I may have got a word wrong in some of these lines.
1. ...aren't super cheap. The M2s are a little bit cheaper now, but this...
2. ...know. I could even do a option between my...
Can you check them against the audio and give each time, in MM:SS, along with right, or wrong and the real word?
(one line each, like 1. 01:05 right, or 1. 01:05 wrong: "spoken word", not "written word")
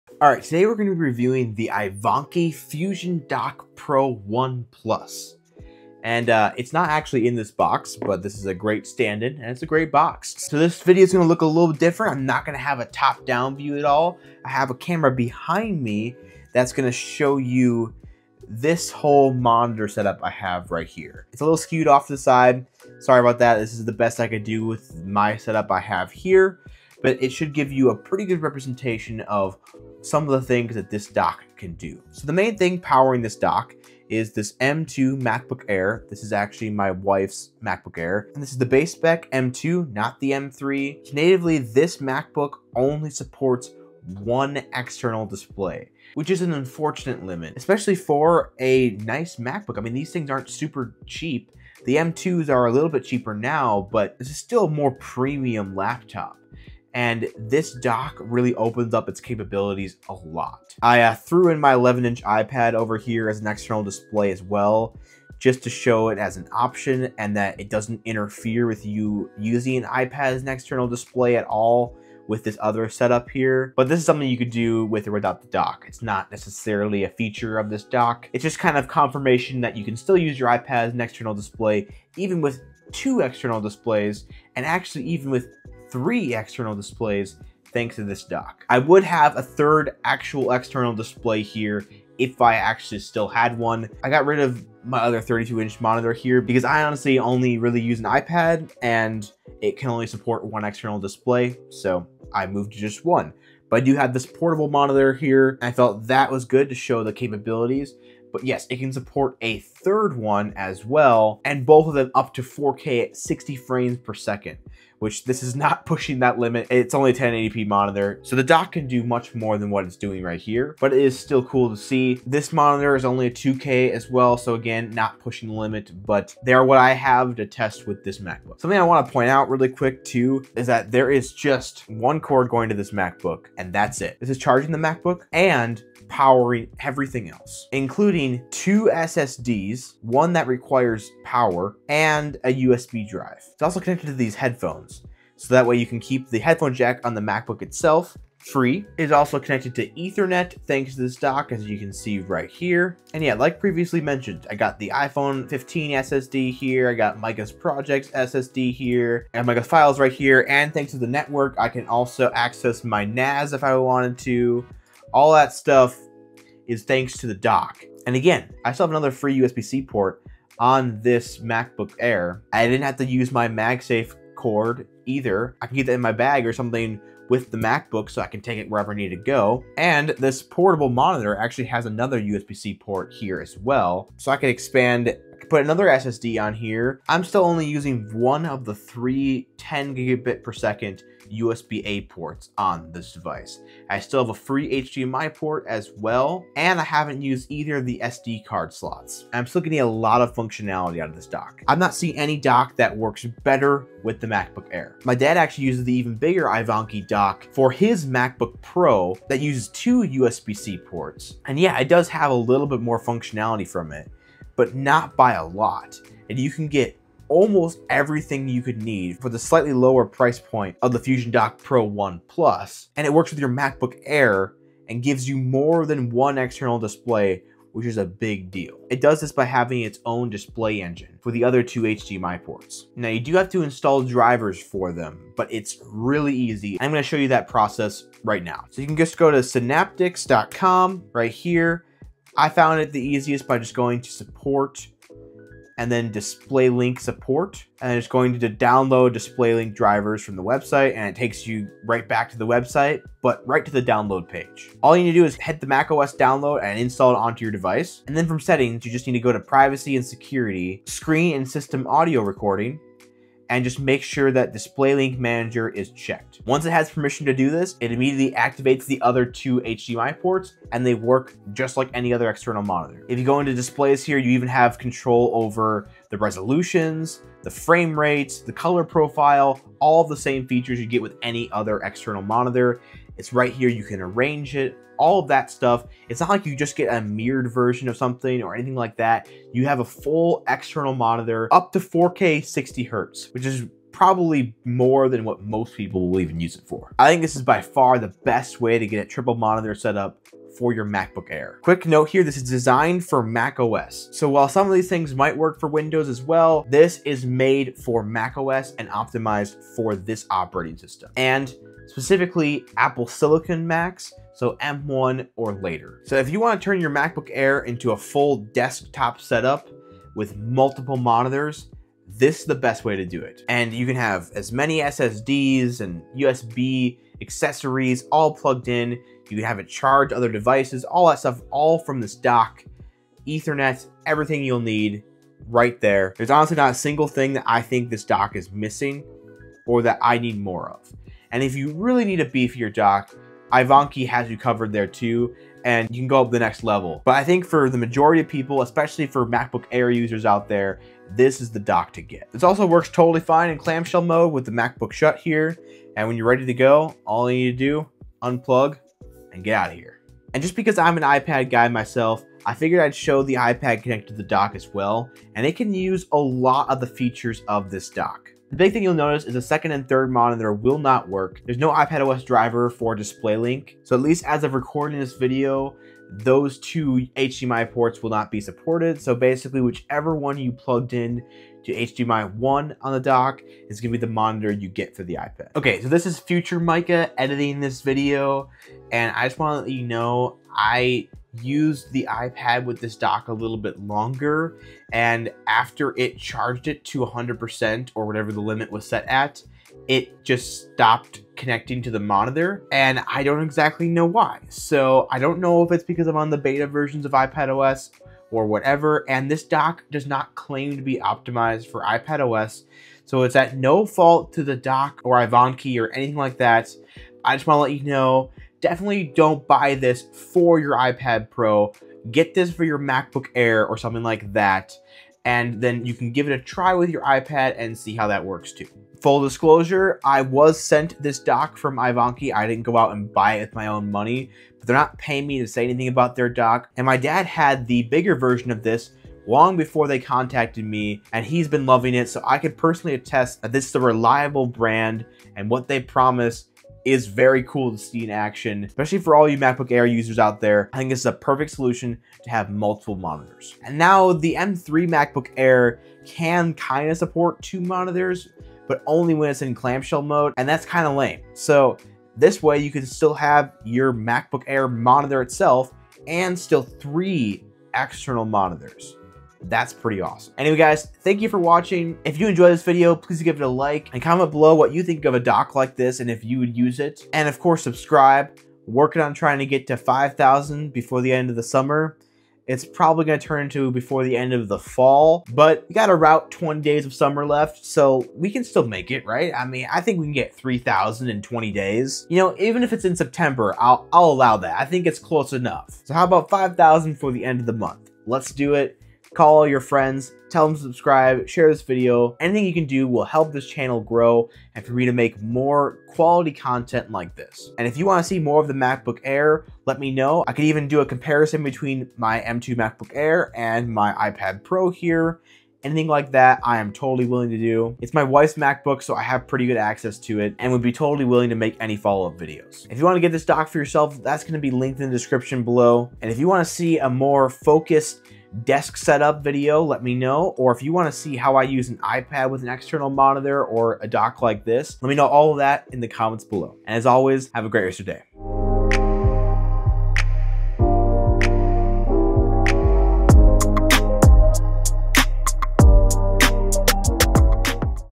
1. 00:50 right
2. 08:29 wrong: "comparison", not "option".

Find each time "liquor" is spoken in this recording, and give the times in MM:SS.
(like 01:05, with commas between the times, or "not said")
not said.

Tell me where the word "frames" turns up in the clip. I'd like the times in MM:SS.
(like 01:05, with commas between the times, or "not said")
01:53, 04:37.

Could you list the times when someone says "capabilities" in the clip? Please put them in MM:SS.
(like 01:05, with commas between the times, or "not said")
00:59, 01:47.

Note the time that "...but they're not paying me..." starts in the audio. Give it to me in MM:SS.
07:14.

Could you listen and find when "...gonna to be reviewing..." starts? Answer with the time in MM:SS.
00:00.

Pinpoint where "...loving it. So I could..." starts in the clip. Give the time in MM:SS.
07:21.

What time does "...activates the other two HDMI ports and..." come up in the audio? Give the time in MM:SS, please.
04:28.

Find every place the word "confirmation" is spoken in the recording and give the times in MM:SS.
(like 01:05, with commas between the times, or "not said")
01:18.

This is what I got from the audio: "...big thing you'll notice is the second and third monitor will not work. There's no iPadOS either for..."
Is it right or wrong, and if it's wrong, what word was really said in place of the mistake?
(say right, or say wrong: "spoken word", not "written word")
wrong: "driver", not "either".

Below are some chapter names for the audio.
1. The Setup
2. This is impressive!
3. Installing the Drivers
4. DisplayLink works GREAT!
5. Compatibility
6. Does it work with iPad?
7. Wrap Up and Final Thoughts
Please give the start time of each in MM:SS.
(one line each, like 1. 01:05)
1. 00:32
2. 02:08
3. 03:53
4. 04:26
5. 05:01
6. 06:00
7. 07:09.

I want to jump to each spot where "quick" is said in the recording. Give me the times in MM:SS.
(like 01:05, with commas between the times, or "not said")
02:09, 05:01.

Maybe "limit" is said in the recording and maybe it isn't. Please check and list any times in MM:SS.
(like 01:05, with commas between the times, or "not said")
00:47, 01:56, 02:05, 06:38.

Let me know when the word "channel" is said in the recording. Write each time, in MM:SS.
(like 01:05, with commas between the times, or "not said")
08:23.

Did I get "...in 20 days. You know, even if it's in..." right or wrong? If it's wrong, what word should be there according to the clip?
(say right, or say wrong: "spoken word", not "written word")
right.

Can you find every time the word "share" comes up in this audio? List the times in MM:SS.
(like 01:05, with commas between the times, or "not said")
08:21.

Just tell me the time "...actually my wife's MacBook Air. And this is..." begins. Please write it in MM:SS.
00:36.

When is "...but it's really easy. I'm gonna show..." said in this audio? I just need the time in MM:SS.
03:55.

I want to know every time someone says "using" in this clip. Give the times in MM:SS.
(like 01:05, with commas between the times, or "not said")
01:09, 03:07.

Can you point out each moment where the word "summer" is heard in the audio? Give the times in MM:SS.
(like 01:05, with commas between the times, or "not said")
08:01, 08:06.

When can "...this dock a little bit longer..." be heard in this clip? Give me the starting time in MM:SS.
06:32.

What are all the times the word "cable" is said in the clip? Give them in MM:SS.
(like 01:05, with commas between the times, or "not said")
not said.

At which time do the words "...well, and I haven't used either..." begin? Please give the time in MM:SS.
03:15.